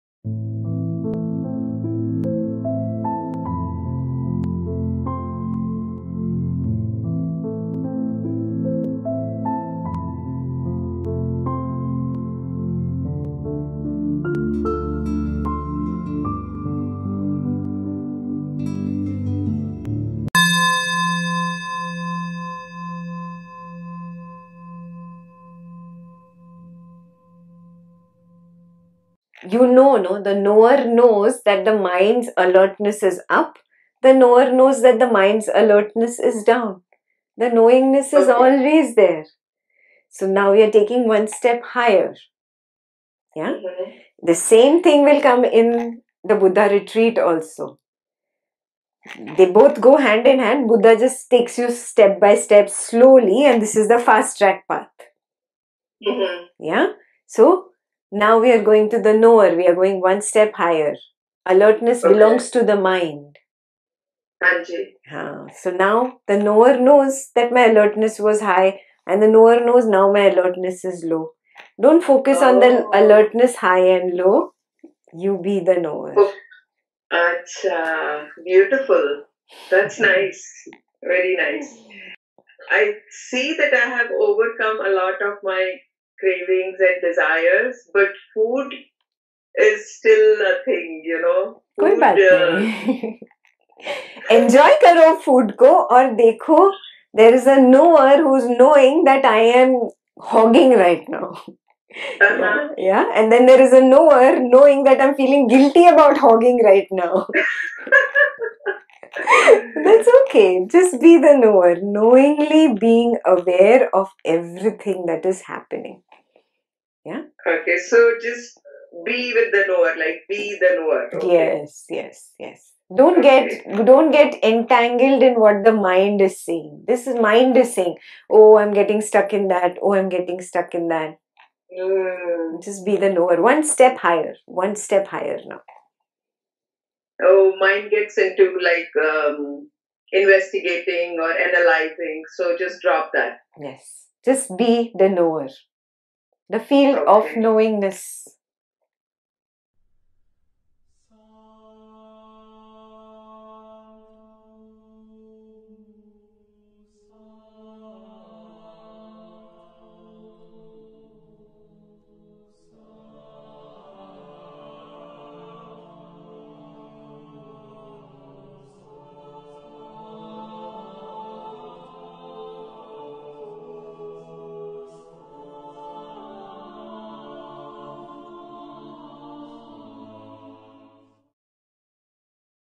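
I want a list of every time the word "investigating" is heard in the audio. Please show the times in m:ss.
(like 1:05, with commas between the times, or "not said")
2:20.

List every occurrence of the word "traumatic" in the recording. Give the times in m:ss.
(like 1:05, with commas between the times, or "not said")
not said.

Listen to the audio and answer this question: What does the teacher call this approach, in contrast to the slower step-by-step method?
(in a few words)
fast track path.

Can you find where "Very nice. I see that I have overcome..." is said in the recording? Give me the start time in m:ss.
1:21.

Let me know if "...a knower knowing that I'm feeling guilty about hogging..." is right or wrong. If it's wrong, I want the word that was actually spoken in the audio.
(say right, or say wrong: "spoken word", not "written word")
right.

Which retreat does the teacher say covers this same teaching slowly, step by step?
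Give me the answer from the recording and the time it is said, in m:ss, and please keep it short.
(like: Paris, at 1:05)
Buddha retreat, at 0:46.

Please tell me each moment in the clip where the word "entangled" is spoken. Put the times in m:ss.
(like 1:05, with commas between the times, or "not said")
2:04.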